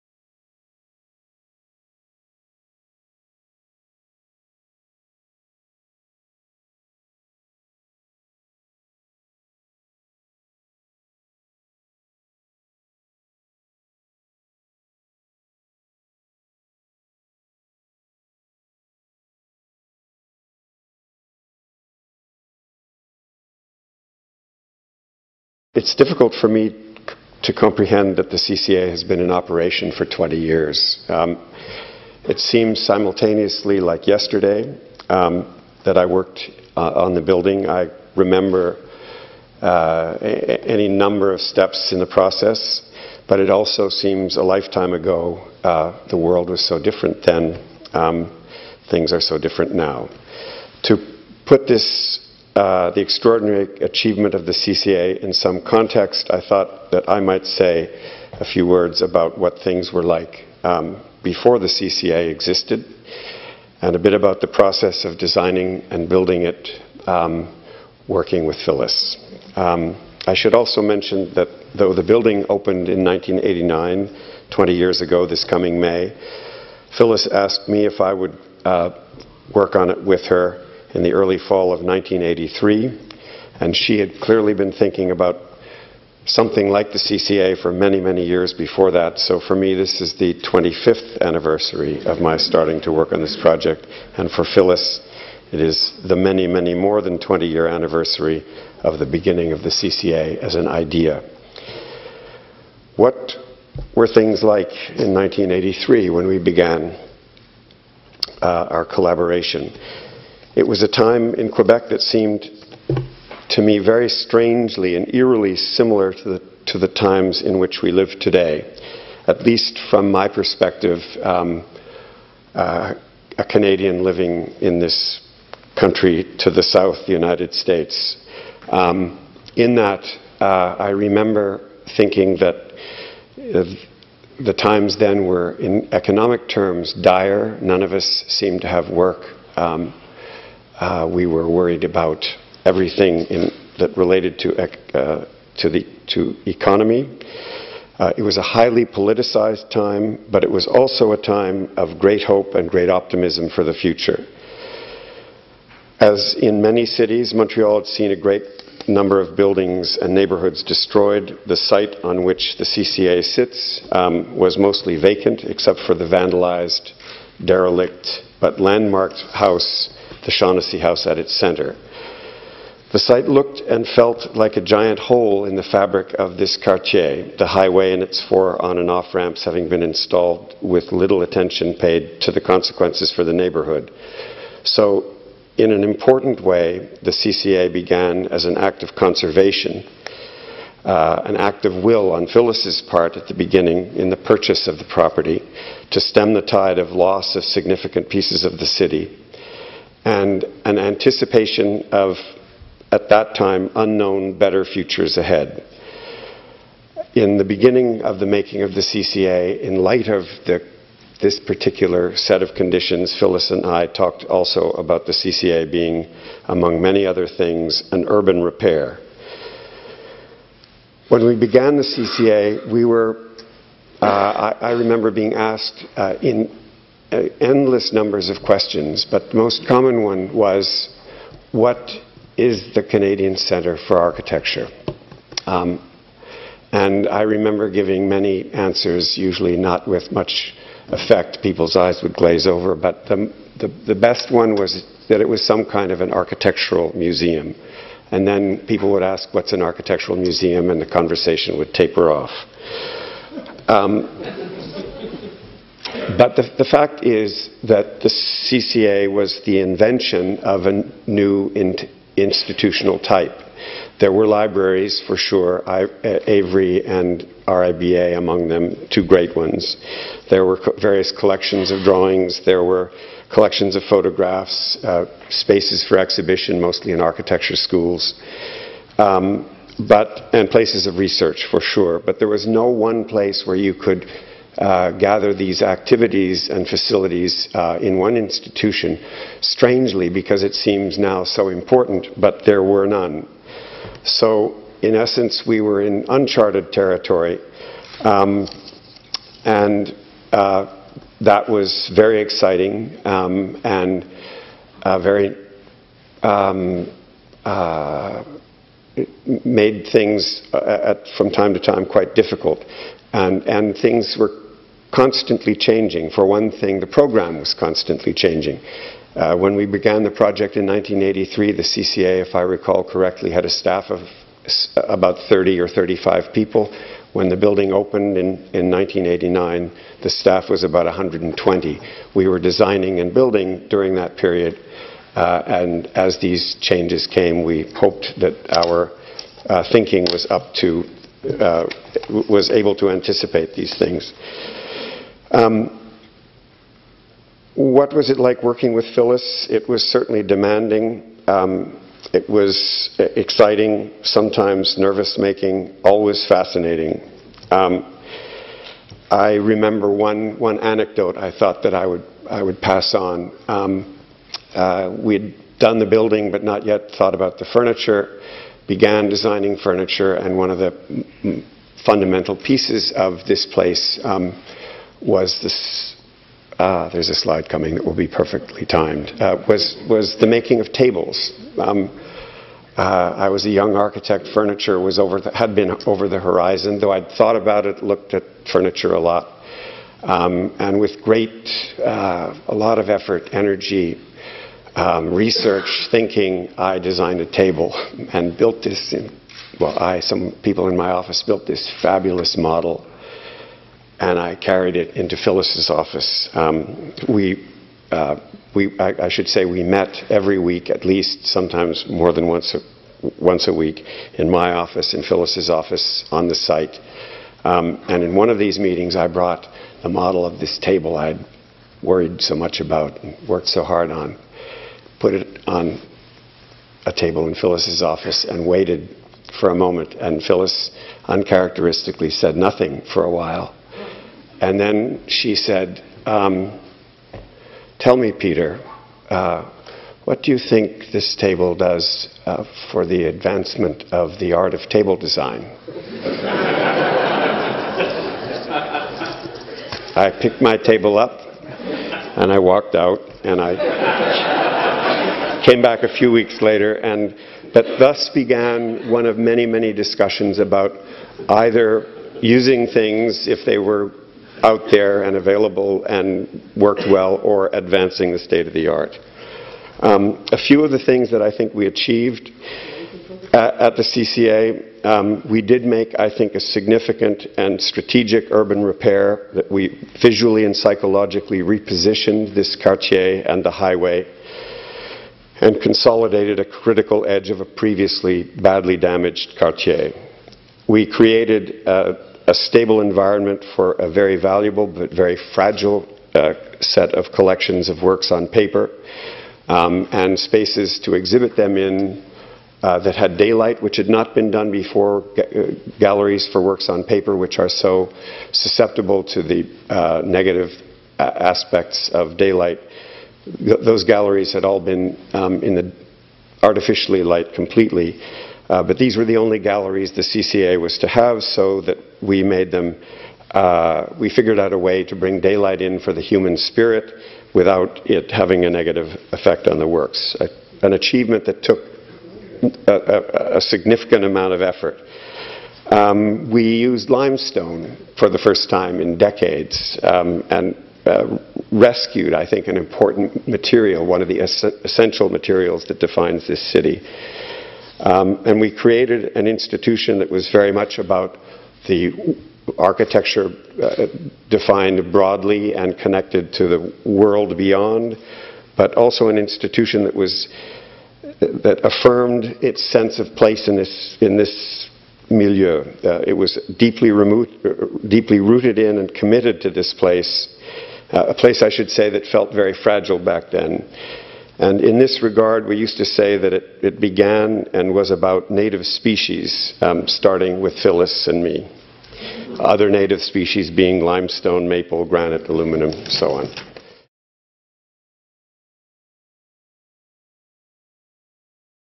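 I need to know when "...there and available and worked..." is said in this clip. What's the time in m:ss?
7:44.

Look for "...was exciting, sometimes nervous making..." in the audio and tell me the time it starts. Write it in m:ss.
5:52.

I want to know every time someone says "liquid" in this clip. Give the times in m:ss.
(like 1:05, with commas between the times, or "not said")
not said.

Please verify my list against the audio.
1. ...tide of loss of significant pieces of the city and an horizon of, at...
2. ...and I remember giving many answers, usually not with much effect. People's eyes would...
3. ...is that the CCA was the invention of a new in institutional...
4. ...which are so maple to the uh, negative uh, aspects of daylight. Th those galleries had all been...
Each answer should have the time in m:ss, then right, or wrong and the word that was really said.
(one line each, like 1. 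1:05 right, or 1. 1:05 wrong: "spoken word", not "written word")
1. 3:16 wrong: "anticipation", not "horizon"
2. 3:56 right
3. 4:17 right
4. 8:27 wrong: "susceptible", not "maple".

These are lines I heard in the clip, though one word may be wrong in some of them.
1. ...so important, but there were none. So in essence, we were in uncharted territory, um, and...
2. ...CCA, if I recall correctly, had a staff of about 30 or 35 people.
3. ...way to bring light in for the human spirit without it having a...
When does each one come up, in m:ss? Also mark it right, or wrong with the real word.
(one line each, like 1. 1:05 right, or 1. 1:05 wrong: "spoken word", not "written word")
1. 4:51 right
2. 5:21 right
3. 8:44 wrong: "daylight", not "light".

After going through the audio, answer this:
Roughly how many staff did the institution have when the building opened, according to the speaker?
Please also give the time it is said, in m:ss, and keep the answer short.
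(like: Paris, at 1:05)
120, at 5:30.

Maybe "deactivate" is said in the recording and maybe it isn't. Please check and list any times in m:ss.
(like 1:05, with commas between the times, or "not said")
not said.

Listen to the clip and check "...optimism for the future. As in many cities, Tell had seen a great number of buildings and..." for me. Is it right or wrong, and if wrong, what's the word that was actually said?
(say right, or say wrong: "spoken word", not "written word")
wrong: "Montreal", not "Tell".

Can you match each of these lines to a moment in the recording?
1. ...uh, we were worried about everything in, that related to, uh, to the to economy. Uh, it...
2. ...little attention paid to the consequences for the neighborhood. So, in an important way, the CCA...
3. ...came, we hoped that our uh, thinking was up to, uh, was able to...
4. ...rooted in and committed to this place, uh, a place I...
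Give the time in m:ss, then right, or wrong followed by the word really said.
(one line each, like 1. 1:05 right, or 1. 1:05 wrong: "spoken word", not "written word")
1. 2:20 right
2. 3:00 right
3. 5:37 right
4. 9:28 right.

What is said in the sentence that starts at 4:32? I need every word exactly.
There were collections of photographs, uh, spaces for exhibition, mostly in architecture schools, um, but, and places of research, for sure.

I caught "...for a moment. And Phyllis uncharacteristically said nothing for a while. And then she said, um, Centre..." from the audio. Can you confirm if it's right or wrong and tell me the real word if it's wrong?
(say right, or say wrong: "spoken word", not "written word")
wrong: "Tell", not "Centre".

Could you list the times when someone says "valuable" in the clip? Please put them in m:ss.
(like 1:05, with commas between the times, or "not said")
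8:14.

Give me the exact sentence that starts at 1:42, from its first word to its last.
What were things like in 1983 when we began uh, our collaboration?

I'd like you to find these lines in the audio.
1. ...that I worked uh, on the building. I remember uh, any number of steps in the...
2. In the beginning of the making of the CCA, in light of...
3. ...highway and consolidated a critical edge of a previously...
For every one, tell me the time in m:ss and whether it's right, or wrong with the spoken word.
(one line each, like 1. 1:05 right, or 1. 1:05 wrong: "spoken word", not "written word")
1. 0:35 right
2. 3:27 right
3. 8:03 right.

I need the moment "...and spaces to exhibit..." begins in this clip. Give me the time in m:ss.
8:19.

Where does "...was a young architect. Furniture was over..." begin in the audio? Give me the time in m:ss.
6:23.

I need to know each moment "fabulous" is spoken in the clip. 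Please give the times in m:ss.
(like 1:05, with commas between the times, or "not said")
6:41.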